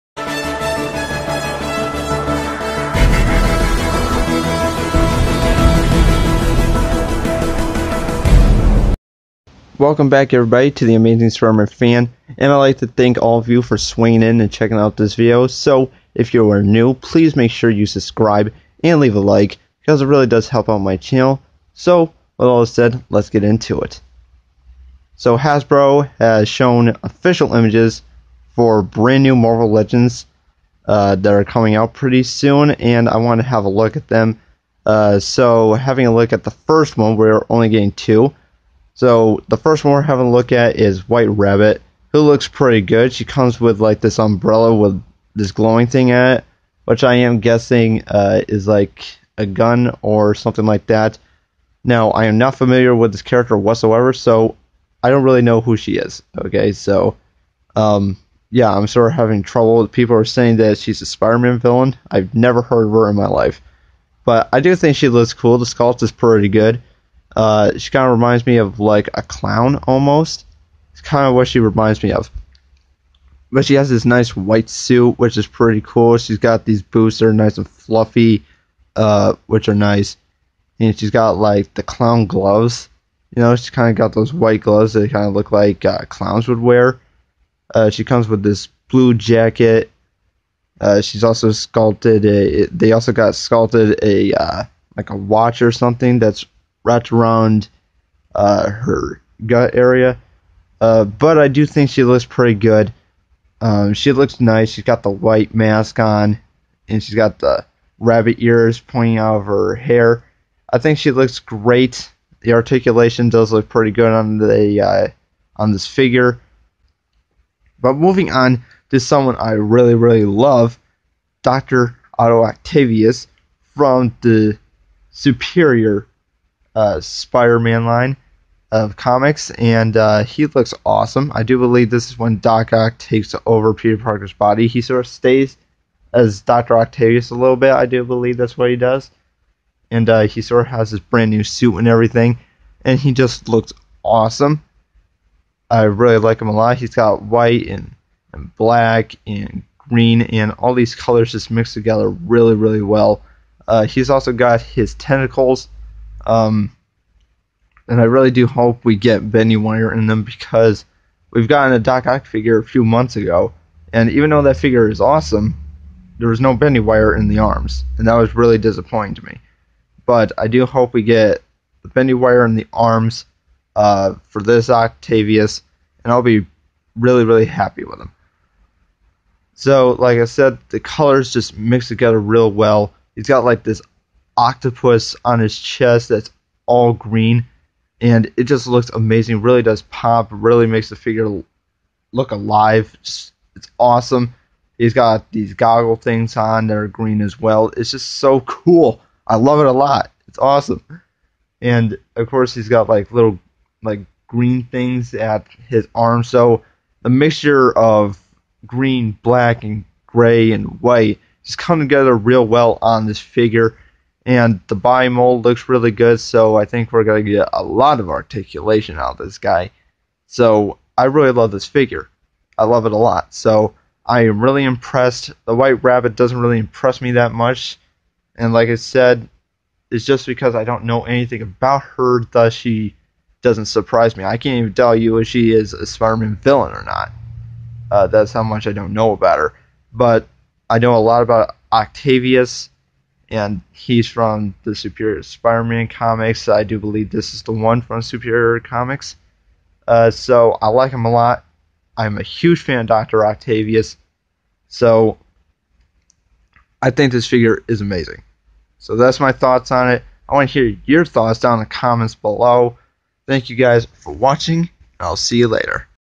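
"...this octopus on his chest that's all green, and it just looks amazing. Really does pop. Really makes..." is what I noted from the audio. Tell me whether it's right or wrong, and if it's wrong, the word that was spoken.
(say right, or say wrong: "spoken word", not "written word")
right.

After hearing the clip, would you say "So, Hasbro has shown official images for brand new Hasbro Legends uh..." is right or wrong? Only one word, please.
wrong.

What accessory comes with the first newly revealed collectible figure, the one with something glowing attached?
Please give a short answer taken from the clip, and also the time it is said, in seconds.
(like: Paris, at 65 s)
Umbrella, at 44 s.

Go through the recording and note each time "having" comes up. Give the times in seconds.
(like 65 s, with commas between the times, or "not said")
35 s, 40 s, 59 s.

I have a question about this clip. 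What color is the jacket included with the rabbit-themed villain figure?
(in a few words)
Blue.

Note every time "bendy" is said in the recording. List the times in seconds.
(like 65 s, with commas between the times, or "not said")
159 s, 166 s, 171 s.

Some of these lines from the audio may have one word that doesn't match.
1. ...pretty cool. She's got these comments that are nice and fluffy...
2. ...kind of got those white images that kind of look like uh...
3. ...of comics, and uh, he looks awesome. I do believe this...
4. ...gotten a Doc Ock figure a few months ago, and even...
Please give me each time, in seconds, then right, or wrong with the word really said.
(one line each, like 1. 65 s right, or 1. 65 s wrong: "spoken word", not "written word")
1. 75 s wrong: "boots", not "comments"
2. 83 s wrong: "gloves", not "images"
3. 128 s right
4. 161 s right.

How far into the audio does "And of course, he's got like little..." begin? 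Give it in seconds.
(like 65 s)
201 s.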